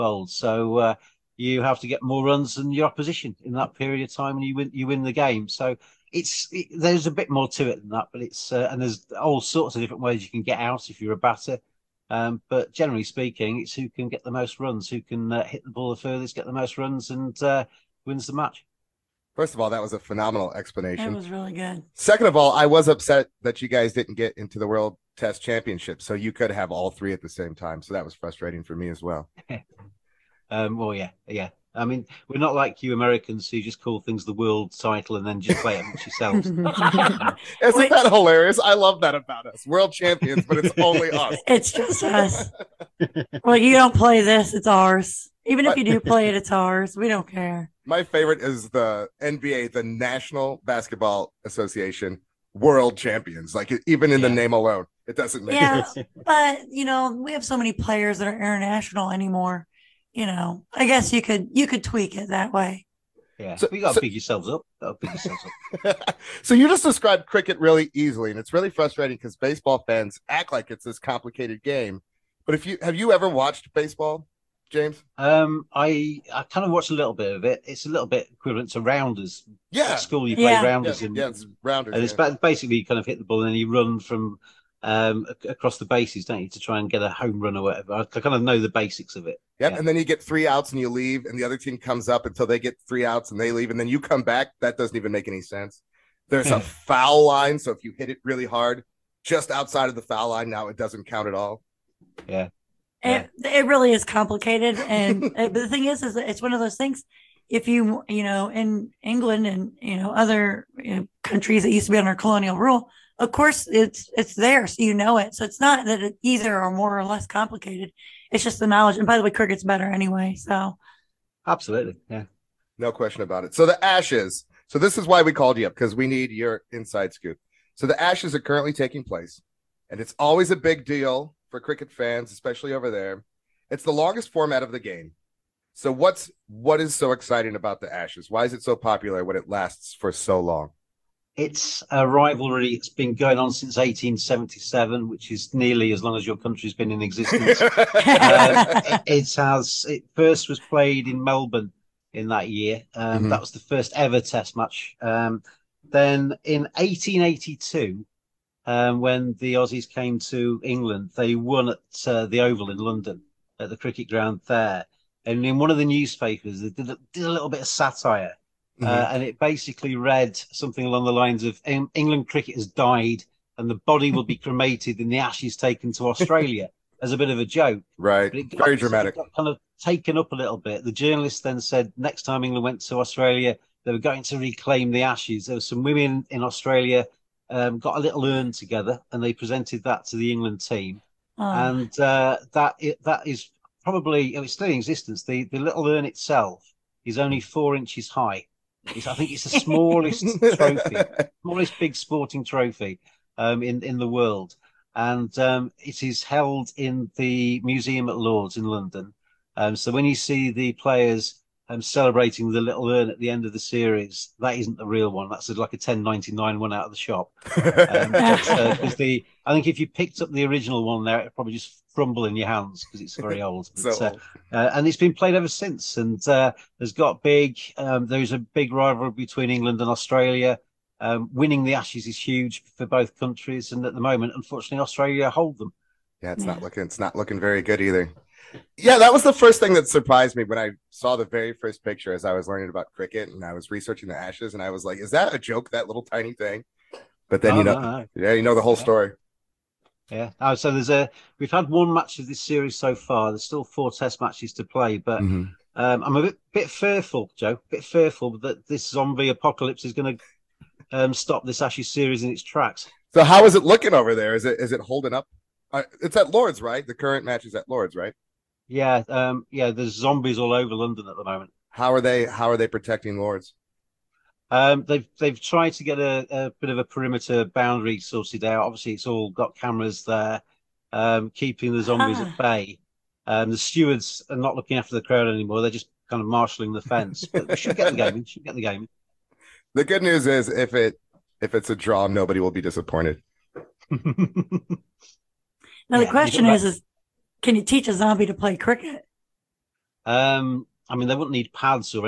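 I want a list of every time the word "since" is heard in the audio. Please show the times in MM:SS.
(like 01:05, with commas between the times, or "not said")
02:23, 03:45.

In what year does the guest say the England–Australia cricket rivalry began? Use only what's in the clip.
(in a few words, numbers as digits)
1877.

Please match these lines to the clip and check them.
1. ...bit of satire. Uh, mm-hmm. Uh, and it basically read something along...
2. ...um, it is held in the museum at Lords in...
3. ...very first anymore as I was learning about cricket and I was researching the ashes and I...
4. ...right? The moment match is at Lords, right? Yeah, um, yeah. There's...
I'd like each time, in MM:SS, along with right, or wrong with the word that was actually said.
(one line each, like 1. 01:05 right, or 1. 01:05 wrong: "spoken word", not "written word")
1. 02:47 right
2. 03:25 right
3. 04:01 wrong: "picture", not "anymore"
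4. 04:26 wrong: "current", not "moment".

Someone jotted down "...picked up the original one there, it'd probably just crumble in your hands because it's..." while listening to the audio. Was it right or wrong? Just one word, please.
right.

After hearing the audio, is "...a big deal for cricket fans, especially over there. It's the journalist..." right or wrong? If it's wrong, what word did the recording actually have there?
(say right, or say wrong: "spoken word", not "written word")
wrong: "longest", not "journalist".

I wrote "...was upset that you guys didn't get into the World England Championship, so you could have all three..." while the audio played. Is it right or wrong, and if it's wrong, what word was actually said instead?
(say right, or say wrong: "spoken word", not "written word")
wrong: "Test", not "England".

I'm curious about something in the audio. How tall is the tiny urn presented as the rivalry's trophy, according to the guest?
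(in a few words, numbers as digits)
4 inches.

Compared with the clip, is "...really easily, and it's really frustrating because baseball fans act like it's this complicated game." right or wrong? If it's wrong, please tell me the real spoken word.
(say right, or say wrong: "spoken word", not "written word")
right.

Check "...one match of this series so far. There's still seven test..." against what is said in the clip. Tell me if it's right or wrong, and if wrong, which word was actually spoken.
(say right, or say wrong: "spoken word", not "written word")
wrong: "four", not "seven".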